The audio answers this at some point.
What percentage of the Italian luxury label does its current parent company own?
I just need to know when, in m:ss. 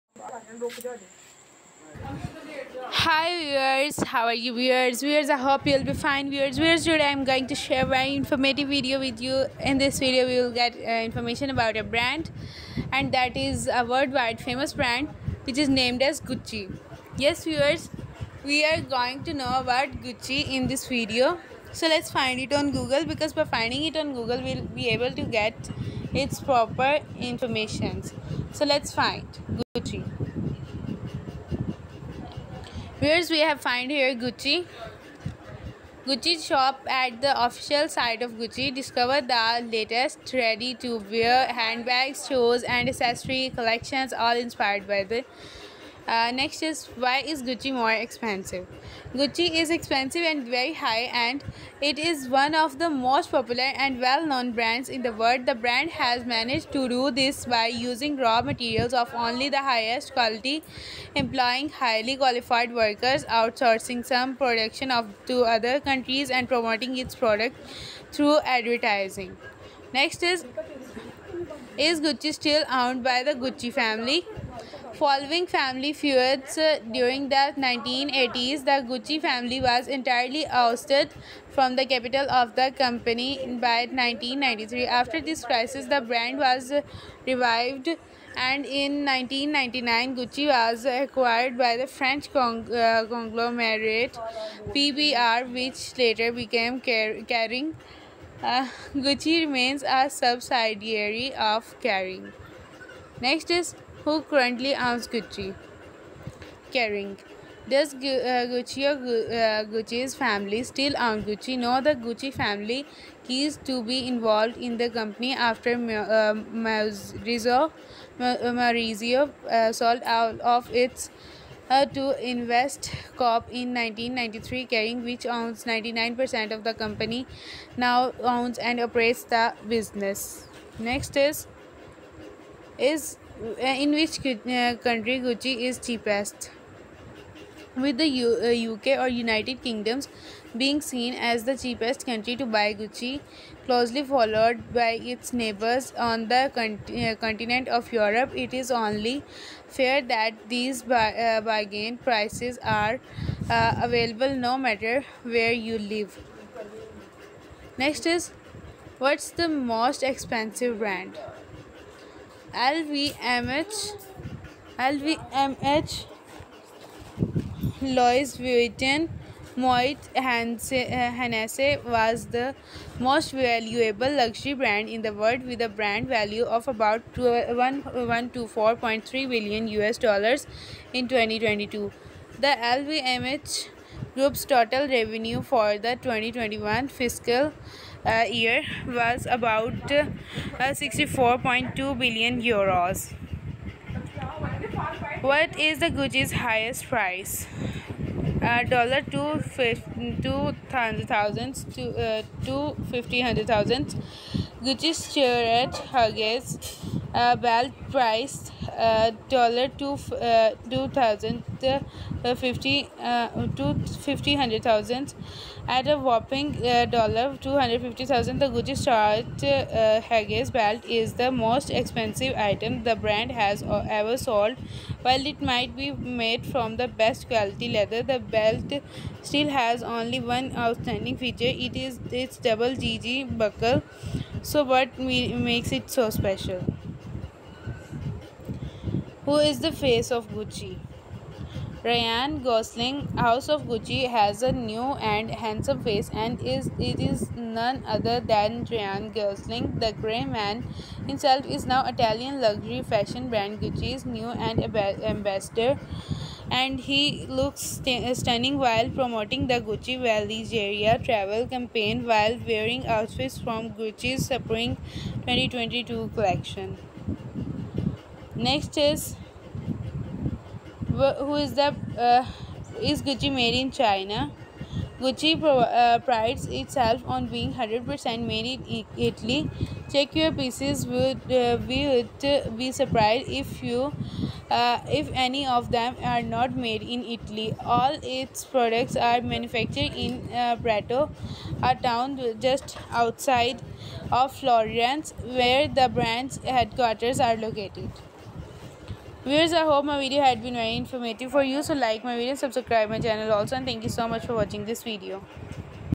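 2:05.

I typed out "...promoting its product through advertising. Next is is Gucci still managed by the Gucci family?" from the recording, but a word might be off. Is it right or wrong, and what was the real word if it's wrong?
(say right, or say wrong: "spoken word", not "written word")
wrong: "owned", not "managed".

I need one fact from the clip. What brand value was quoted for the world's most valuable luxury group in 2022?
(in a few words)
124.3 billion US dollars.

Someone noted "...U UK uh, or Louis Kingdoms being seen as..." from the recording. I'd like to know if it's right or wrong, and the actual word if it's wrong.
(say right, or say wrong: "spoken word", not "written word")
wrong: "United", not "Louis".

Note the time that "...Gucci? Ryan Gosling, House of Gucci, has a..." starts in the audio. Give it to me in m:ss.
4:00.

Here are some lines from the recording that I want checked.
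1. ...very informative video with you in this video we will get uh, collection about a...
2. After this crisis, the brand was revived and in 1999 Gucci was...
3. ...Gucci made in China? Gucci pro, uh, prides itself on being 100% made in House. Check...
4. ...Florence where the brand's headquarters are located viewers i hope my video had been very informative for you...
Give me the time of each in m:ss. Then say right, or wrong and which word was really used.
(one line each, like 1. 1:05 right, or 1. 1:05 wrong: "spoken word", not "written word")
1. 0:07 wrong: "information", not "collection"
2. 1:24 right
3. 4:33 wrong: "Italy", not "House"
4. 4:54 right.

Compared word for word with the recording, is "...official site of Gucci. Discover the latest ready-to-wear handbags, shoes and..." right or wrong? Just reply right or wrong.
right.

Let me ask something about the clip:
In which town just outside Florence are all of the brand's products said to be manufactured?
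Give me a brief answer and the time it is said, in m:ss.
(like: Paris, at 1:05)
Prato, at 4:50.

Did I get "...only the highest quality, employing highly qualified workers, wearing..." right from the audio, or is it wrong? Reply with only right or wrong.
wrong.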